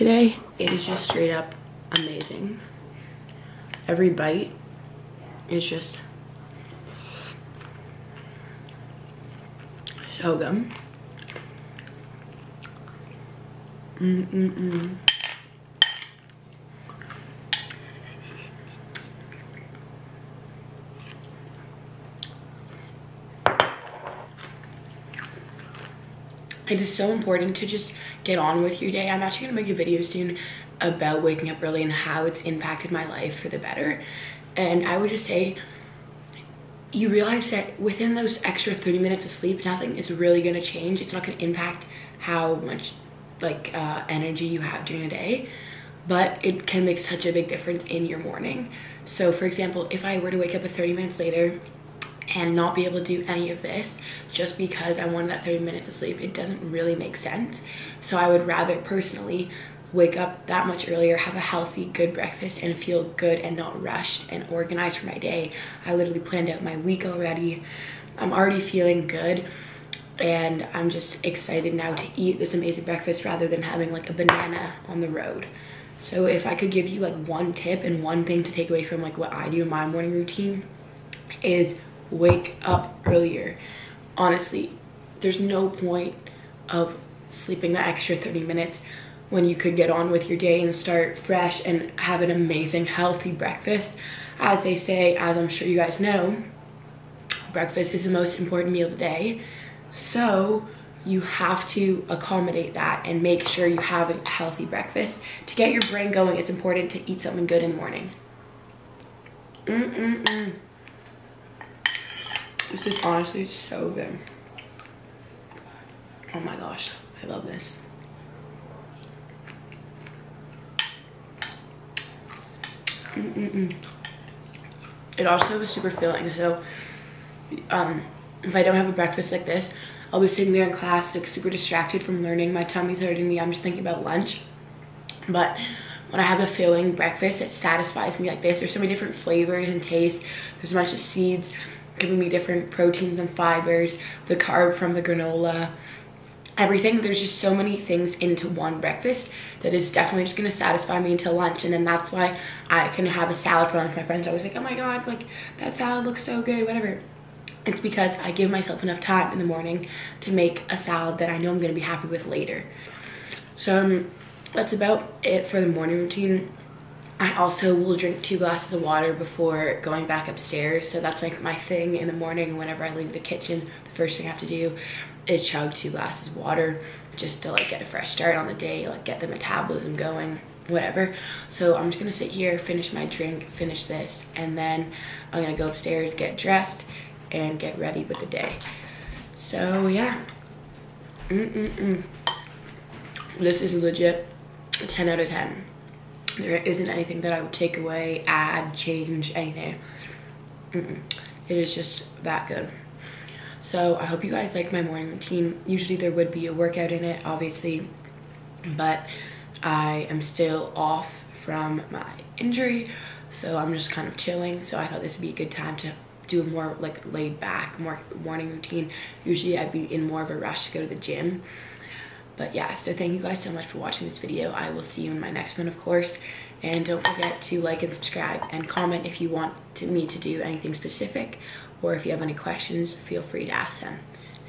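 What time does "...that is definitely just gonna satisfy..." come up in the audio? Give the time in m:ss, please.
2:29.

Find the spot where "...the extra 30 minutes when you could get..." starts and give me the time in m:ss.
1:27.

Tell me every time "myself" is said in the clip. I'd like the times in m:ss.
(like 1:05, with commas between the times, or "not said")
2:38.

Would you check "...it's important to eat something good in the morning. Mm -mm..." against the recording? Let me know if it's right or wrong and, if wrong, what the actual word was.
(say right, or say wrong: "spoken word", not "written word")
right.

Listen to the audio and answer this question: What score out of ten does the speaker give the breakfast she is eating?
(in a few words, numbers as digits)
10.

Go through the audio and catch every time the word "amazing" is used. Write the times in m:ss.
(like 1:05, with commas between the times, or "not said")
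0:01, 1:12, 1:32.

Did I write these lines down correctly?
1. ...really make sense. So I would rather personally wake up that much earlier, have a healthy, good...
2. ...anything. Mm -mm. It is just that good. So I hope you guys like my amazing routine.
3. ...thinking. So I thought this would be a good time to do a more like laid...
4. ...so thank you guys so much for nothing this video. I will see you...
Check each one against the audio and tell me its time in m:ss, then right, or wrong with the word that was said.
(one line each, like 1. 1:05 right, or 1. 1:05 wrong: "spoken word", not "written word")
1. 0:56 right
2. 3:19 wrong: "morning", not "amazing"
3. 3:34 wrong: "chilling", not "thinking"
4. 3:42 wrong: "watching", not "nothing".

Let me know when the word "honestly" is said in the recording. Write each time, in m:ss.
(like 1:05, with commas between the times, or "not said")
1:24, 1:53.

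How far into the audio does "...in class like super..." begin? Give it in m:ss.
2:10.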